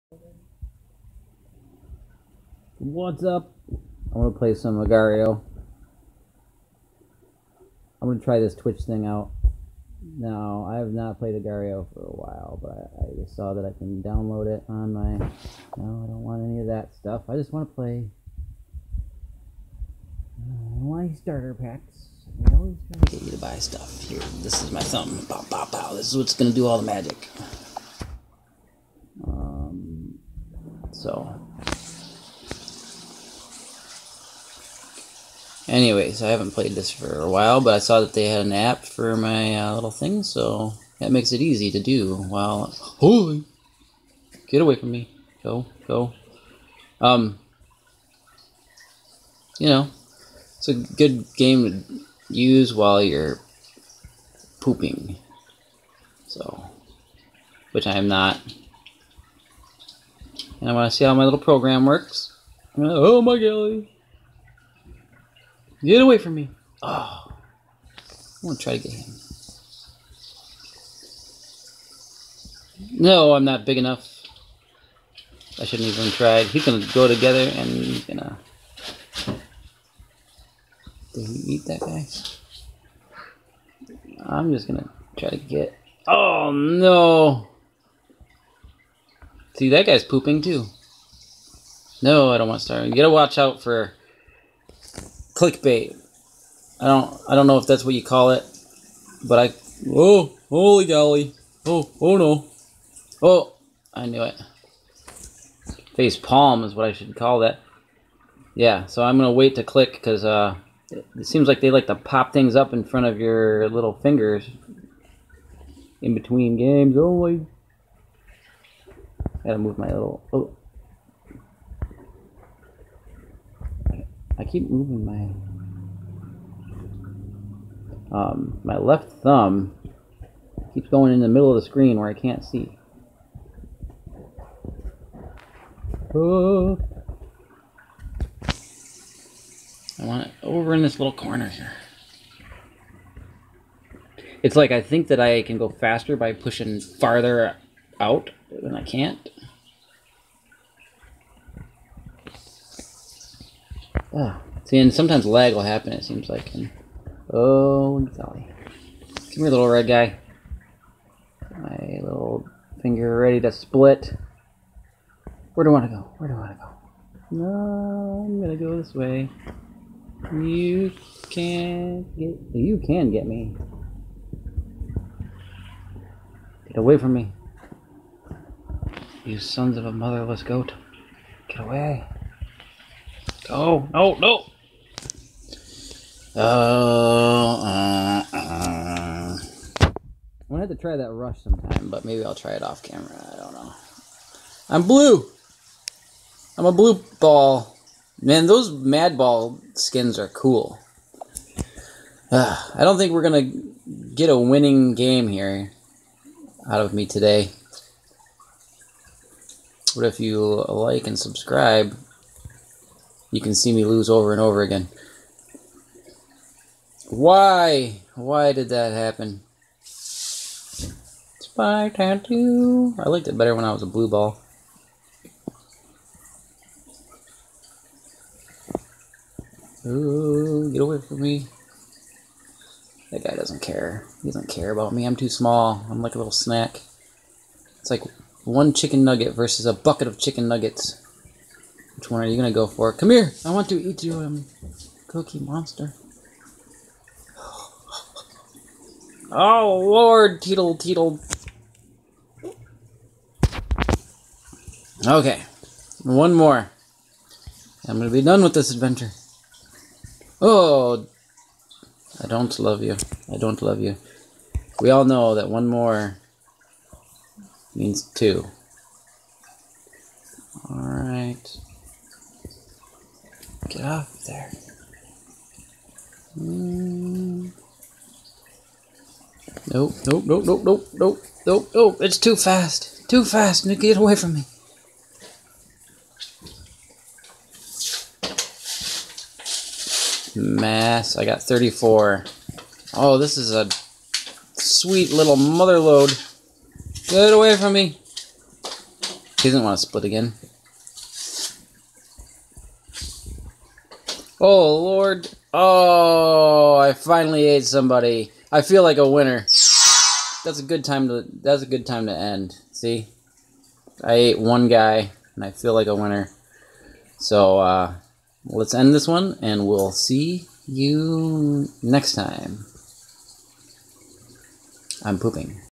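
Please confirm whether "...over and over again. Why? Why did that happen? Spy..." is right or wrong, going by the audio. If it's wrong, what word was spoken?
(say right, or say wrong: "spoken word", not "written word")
right.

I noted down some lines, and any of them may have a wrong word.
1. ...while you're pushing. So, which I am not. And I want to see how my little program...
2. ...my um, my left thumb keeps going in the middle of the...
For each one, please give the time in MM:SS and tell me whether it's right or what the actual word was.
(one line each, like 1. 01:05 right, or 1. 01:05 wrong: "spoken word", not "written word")
1. 00:52 wrong: "pooping", not "pushing"
2. 02:05 right.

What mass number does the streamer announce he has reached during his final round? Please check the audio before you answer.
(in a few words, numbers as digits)
34.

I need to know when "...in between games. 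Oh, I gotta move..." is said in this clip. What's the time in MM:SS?
01:56.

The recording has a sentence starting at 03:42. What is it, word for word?
I liked it better when I was a blue ball.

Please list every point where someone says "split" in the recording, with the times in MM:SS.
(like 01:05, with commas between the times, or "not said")
02:43, 04:59.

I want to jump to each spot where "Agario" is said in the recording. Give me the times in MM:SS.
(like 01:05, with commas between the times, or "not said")
00:04, 00:11.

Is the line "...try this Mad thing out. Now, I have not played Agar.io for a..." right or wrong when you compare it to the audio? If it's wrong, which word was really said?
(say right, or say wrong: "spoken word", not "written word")
wrong: "Twitch", not "Mad".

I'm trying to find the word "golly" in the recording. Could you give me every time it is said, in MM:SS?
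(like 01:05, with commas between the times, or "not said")
01:03, 01:40, 02:37.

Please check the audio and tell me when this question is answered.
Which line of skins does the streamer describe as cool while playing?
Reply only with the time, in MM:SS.
03:18.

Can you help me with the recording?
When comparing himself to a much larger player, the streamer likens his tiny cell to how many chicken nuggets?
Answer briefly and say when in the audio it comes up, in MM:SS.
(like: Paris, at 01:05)
1, at 03:58.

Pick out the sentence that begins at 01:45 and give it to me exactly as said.
Face palm is what I should call that.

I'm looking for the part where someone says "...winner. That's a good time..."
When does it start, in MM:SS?
05:09.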